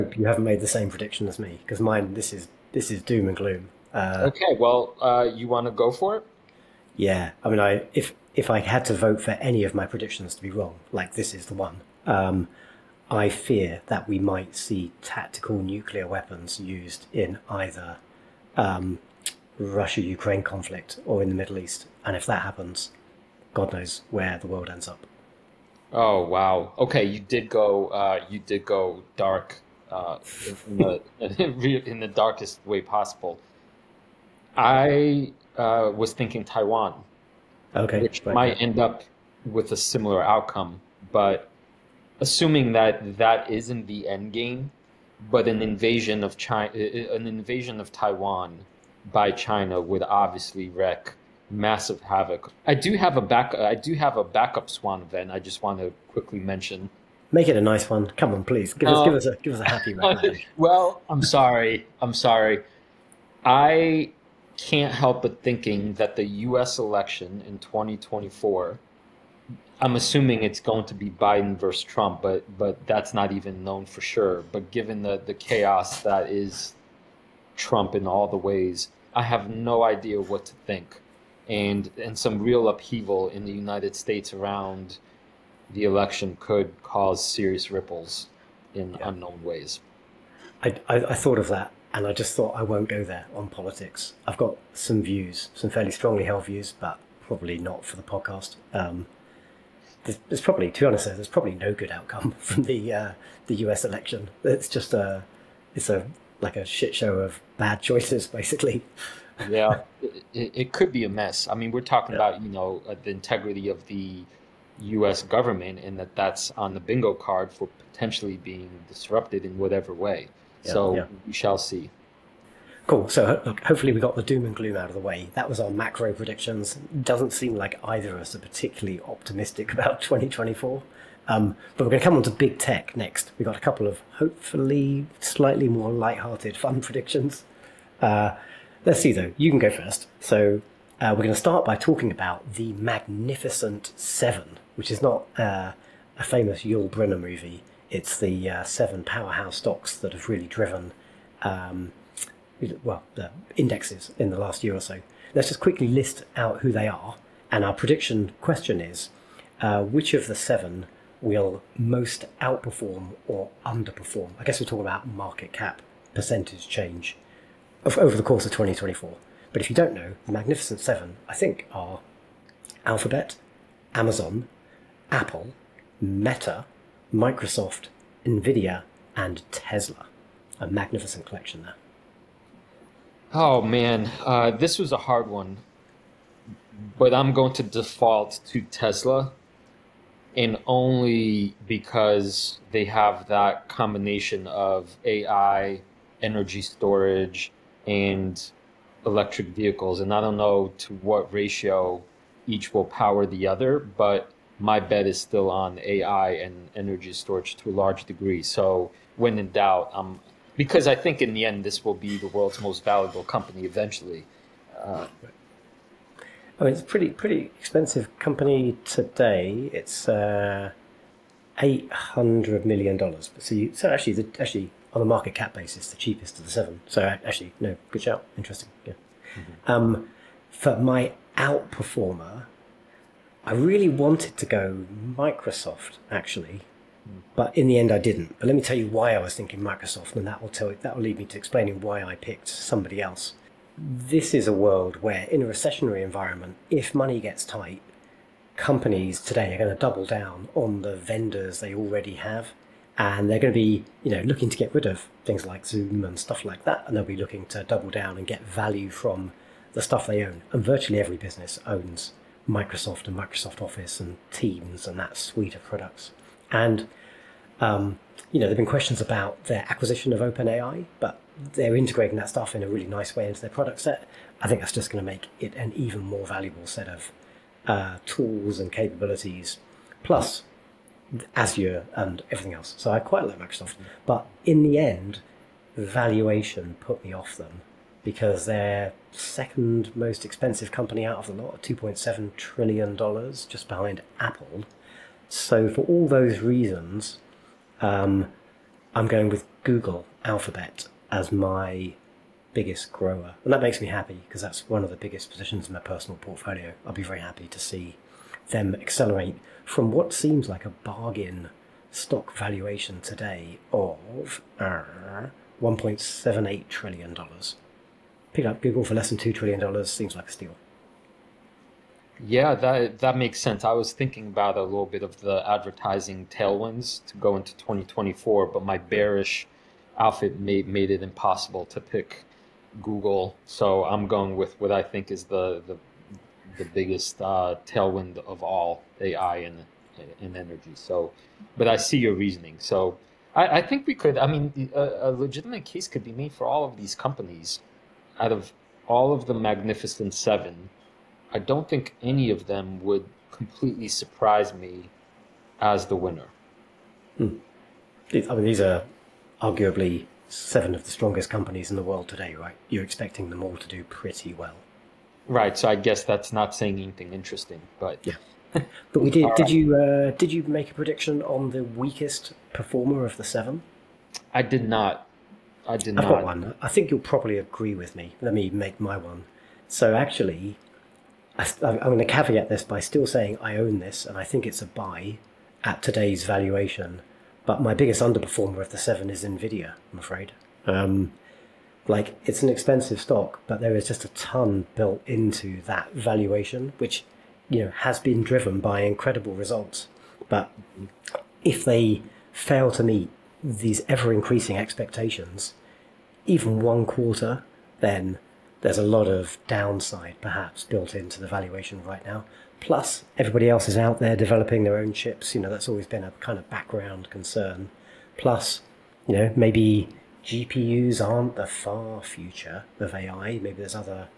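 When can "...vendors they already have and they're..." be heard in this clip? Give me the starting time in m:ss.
4:10.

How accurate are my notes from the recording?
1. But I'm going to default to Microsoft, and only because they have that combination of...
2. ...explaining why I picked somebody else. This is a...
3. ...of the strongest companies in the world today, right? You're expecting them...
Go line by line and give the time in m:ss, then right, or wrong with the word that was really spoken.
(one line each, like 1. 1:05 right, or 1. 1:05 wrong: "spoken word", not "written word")
1. 3:06 wrong: "Tesla", not "Microsoft"
2. 4:01 right
3. 6:00 right.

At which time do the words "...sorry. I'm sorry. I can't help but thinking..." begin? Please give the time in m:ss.
1:01.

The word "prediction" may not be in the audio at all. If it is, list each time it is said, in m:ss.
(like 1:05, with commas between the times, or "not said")
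0:00, 0:09, 2:06, 2:16, 2:37, 6:10.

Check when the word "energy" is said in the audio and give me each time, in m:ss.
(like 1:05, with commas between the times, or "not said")
3:16, 3:26, 5:40.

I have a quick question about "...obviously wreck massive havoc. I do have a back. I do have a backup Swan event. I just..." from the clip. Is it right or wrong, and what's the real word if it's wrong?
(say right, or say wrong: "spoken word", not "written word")
right.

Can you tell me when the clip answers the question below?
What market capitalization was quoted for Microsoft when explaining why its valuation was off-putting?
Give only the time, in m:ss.
4:51.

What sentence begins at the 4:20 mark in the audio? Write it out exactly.
And virtually every business owns Microsoft and Microsoft Office and Teams and that suite of products.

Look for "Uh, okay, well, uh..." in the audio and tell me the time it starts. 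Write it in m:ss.
0:03.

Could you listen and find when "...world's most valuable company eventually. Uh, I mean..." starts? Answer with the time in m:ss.
3:32.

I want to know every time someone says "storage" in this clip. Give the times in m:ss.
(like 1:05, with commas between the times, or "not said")
3:16, 3:27.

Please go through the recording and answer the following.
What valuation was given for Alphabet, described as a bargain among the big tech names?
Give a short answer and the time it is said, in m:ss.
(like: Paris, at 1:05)
$1.78 trillion, at 5:15.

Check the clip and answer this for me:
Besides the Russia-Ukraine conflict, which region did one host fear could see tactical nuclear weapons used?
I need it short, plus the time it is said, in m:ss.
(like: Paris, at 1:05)
Middle East, at 0:21.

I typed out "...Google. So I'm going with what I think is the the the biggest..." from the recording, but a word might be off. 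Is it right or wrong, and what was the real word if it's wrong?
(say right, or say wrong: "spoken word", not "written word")
right.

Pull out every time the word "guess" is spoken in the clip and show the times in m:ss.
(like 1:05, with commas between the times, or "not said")
2:44, 6:05.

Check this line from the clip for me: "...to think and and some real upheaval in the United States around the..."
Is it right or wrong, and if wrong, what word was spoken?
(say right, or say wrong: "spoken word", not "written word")
right.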